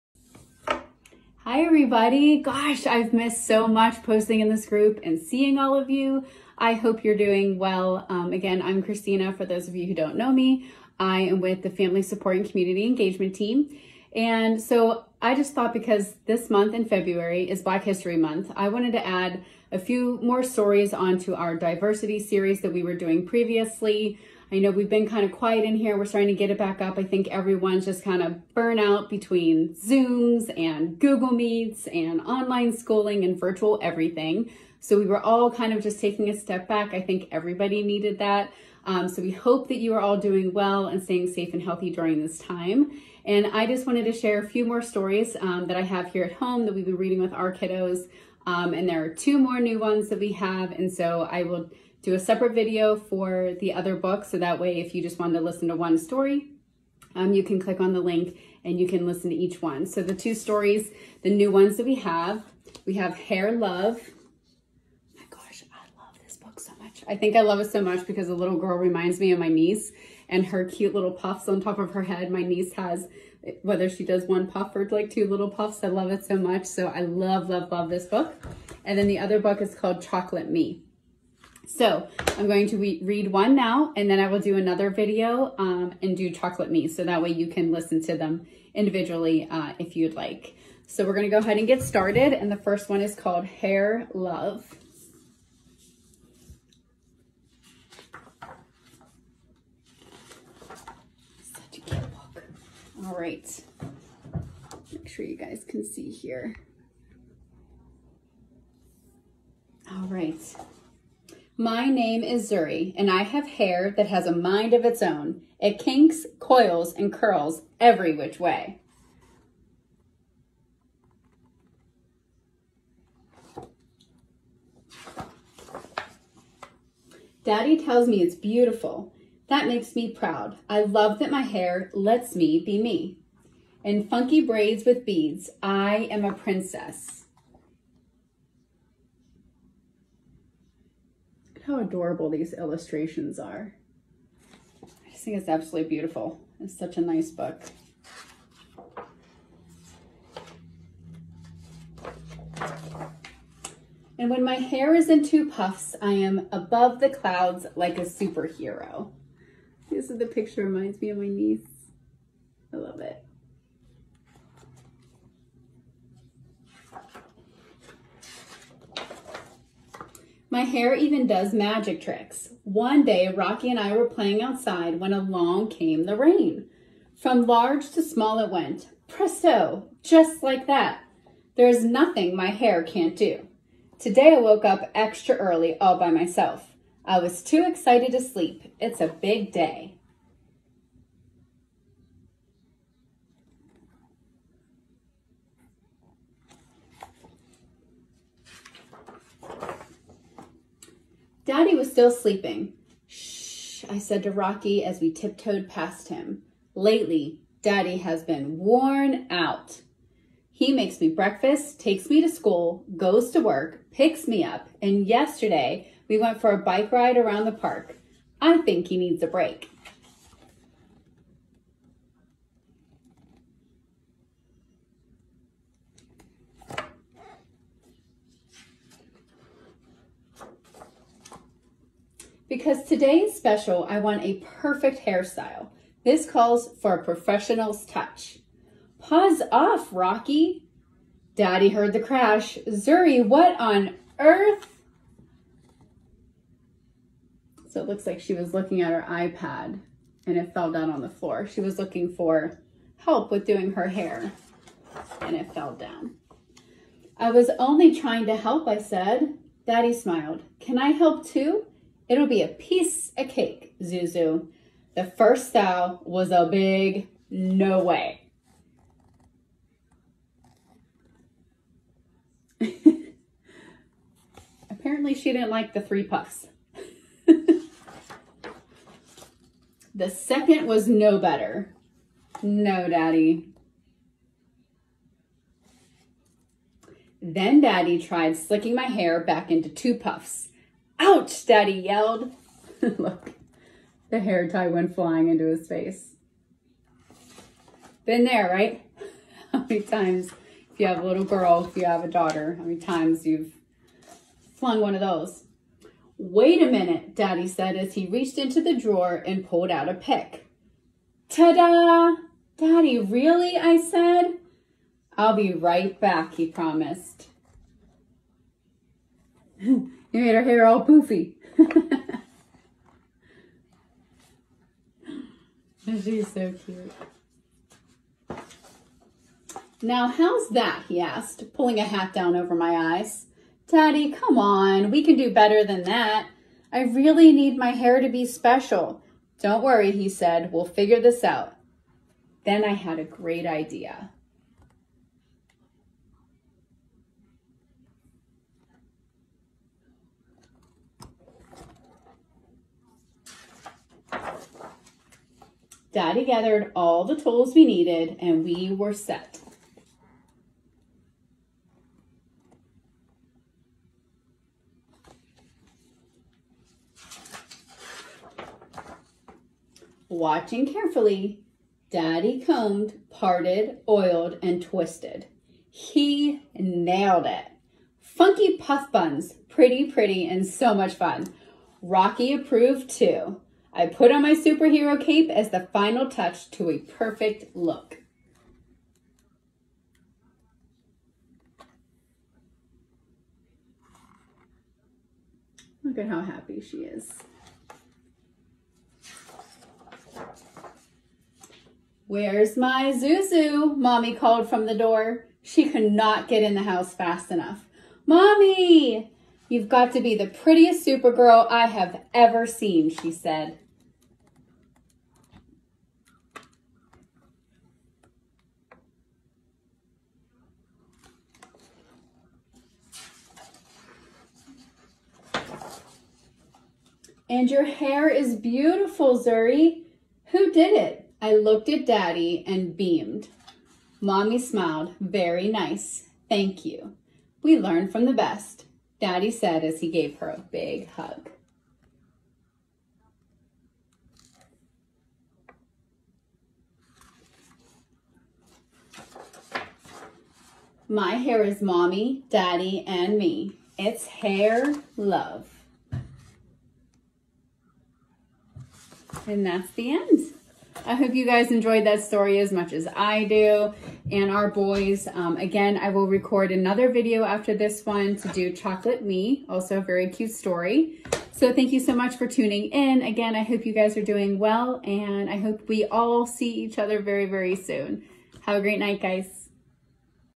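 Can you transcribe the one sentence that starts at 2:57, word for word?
From large to small it went.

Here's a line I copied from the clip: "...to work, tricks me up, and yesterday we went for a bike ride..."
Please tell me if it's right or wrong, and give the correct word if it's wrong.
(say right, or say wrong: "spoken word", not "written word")
wrong: "picks", not "tricks".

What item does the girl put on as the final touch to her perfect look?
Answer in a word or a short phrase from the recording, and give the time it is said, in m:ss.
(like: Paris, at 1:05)
Superhero cape, at 6:24.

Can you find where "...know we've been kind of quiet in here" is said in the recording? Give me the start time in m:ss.
0:24.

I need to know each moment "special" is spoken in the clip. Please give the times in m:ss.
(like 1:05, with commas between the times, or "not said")
3:53, 5:38.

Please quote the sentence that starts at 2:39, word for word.
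This is the picture reminds me of my niece.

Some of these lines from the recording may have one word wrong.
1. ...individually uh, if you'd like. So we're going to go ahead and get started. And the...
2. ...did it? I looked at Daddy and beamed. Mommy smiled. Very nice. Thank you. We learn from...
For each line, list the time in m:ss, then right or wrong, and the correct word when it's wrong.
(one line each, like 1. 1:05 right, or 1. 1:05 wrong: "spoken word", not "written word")
1. 1:28 right
2. 7:10 right.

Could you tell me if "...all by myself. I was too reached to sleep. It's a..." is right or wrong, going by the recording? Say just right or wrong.
wrong.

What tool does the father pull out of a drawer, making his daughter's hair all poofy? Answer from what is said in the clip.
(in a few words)
A pick.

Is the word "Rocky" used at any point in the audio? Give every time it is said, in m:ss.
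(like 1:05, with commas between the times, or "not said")
2:53, 3:24, 3:59, 6:21.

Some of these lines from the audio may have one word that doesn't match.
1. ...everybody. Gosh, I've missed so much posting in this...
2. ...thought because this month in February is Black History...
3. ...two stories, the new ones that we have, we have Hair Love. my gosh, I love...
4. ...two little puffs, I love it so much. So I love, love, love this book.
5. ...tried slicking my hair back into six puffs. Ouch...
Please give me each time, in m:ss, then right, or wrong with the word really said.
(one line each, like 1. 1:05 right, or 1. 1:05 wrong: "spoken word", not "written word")
1. 0:01 right
2. 0:15 right
3. 1:00 right
4. 1:15 right
5. 4:48 wrong: "two", not "six".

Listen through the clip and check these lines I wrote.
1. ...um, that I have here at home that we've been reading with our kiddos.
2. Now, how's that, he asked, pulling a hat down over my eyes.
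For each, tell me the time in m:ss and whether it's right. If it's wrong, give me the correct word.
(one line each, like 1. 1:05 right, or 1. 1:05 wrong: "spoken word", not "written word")
1. 0:45 right
2. 5:29 right.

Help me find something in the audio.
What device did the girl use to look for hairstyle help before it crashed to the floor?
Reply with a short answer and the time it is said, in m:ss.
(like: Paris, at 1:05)
iPad, at 4:09.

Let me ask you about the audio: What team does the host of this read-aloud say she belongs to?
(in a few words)
Family Support and Community Engagement Team.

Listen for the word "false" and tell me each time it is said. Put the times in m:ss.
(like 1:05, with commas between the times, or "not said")
not said.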